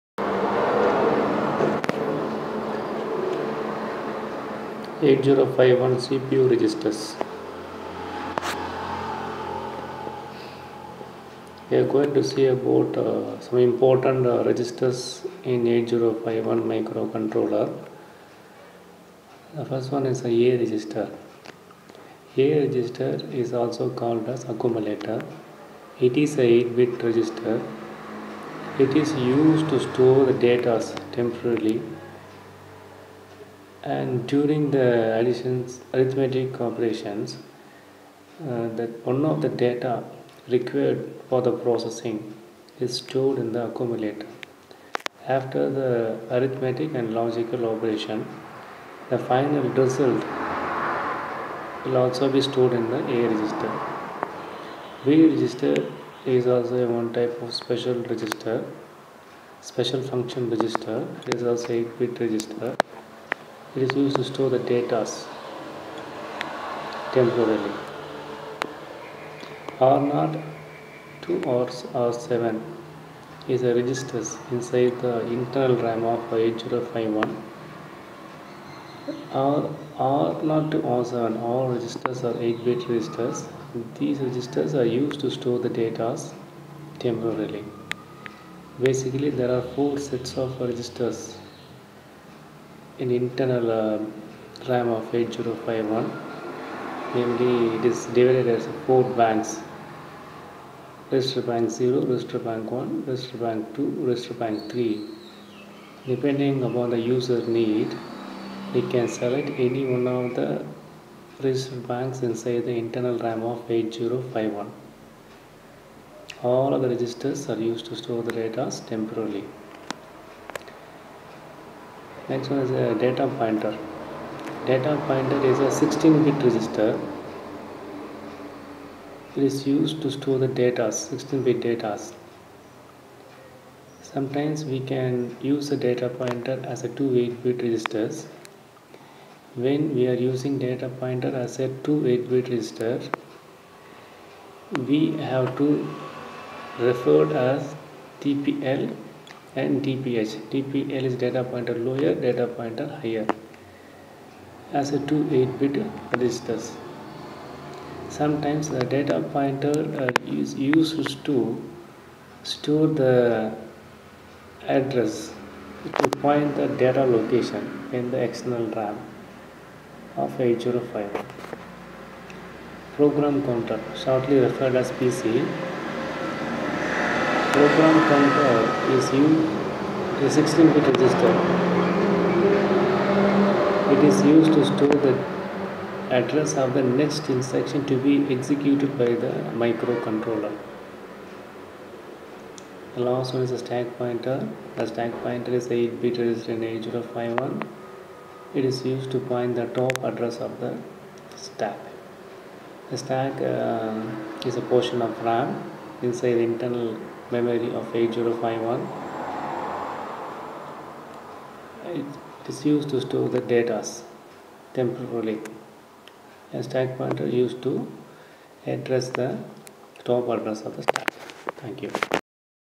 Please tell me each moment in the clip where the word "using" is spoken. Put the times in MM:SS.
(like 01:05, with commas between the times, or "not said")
02:20.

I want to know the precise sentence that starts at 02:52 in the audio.
Program counter, shortly referred as PC, program counter is used a 16-bit register.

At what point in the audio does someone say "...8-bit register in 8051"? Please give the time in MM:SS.
03:15.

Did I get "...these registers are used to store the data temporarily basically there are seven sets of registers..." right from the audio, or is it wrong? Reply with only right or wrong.
wrong.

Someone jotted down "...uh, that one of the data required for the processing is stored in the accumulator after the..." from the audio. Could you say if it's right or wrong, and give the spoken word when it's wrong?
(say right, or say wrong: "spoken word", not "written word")
right.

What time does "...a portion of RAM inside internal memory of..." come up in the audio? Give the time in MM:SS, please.
03:24.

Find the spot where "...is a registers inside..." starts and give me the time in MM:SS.
01:13.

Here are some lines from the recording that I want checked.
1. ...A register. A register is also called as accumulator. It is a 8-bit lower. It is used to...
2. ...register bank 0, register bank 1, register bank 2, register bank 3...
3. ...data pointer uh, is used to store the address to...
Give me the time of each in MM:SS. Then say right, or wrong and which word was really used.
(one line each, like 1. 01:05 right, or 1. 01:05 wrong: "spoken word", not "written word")
1. 00:20 wrong: "register", not "lower"
2. 01:41 right
3. 02:38 right.